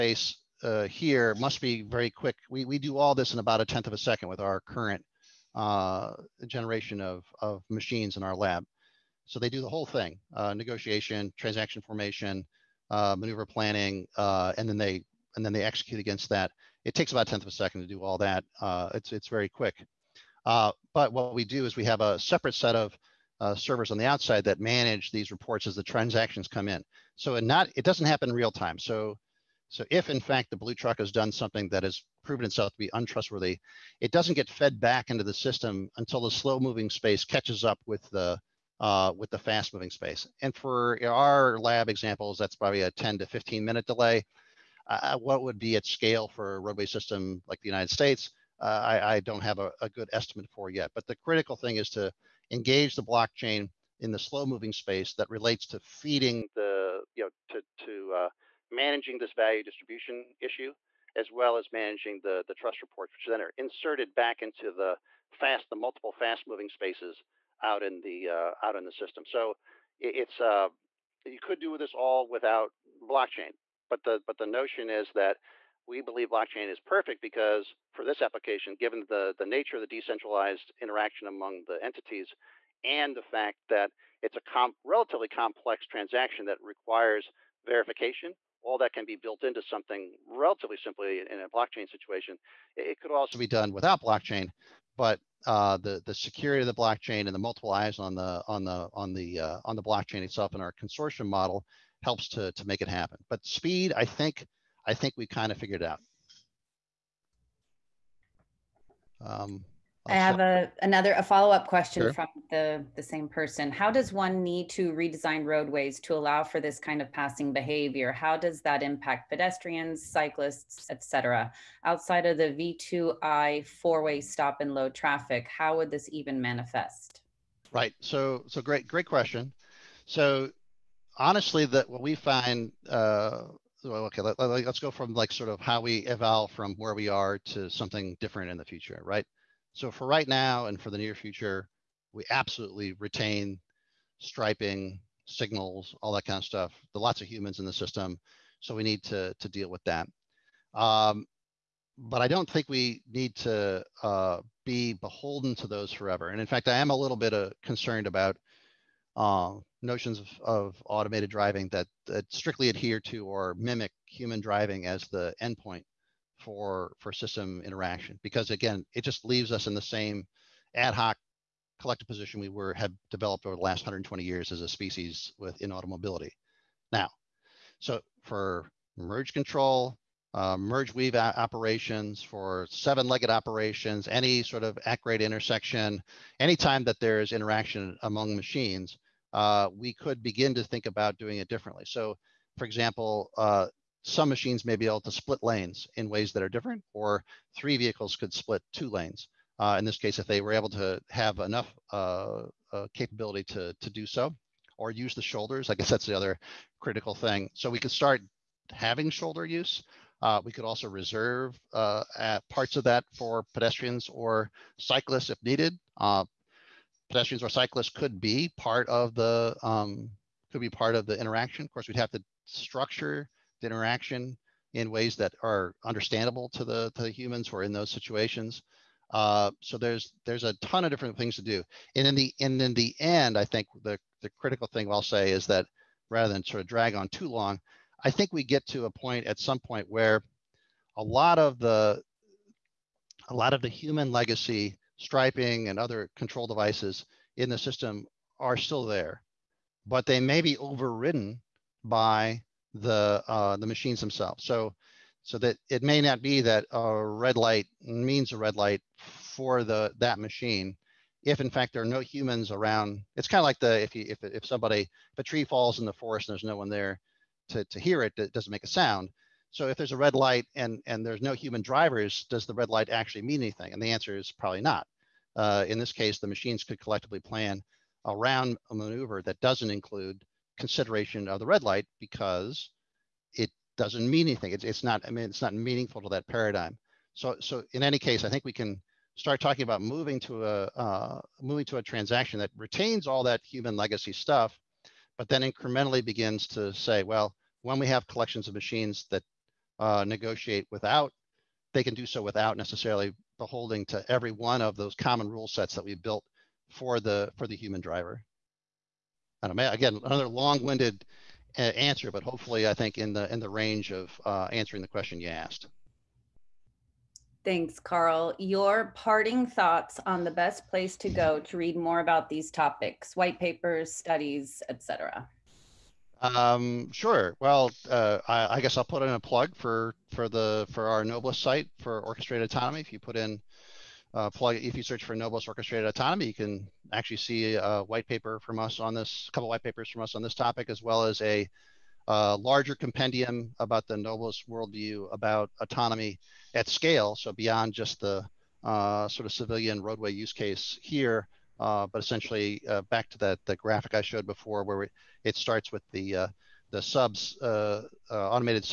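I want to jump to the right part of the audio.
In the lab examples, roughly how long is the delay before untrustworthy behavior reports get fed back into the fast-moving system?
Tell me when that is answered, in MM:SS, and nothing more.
00:42.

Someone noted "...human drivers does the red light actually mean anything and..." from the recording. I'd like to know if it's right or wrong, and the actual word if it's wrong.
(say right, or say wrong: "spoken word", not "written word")
right.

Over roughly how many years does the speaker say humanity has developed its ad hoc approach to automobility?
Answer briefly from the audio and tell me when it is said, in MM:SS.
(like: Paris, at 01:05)
120 years, at 02:53.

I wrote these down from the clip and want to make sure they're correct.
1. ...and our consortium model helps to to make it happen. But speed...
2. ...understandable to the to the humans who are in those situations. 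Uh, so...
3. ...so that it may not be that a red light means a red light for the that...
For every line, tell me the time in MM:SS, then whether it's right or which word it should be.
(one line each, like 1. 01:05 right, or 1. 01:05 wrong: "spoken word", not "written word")
1. 01:40 right
2. 03:45 right
3. 04:15 right.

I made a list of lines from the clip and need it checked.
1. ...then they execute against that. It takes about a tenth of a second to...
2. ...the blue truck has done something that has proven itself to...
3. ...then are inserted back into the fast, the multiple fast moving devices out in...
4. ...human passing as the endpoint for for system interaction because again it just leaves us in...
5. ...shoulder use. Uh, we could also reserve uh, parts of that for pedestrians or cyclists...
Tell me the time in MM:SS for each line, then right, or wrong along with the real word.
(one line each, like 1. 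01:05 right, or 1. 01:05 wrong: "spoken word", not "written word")
1. 00:15 right
2. 00:30 right
3. 01:03 wrong: "spaces", not "devices"
4. 02:44 wrong: "driving", not "passing"
5. 03:29 right.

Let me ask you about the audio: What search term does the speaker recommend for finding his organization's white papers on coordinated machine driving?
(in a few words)
Noblis orchestrated autonomy.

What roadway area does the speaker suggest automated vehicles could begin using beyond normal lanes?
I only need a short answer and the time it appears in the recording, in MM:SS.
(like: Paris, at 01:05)
shoulders, at 03:25.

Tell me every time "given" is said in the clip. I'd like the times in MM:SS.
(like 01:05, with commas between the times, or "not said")
01:18.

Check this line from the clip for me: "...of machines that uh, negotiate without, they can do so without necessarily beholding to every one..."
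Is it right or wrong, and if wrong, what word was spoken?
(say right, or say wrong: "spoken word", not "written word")
right.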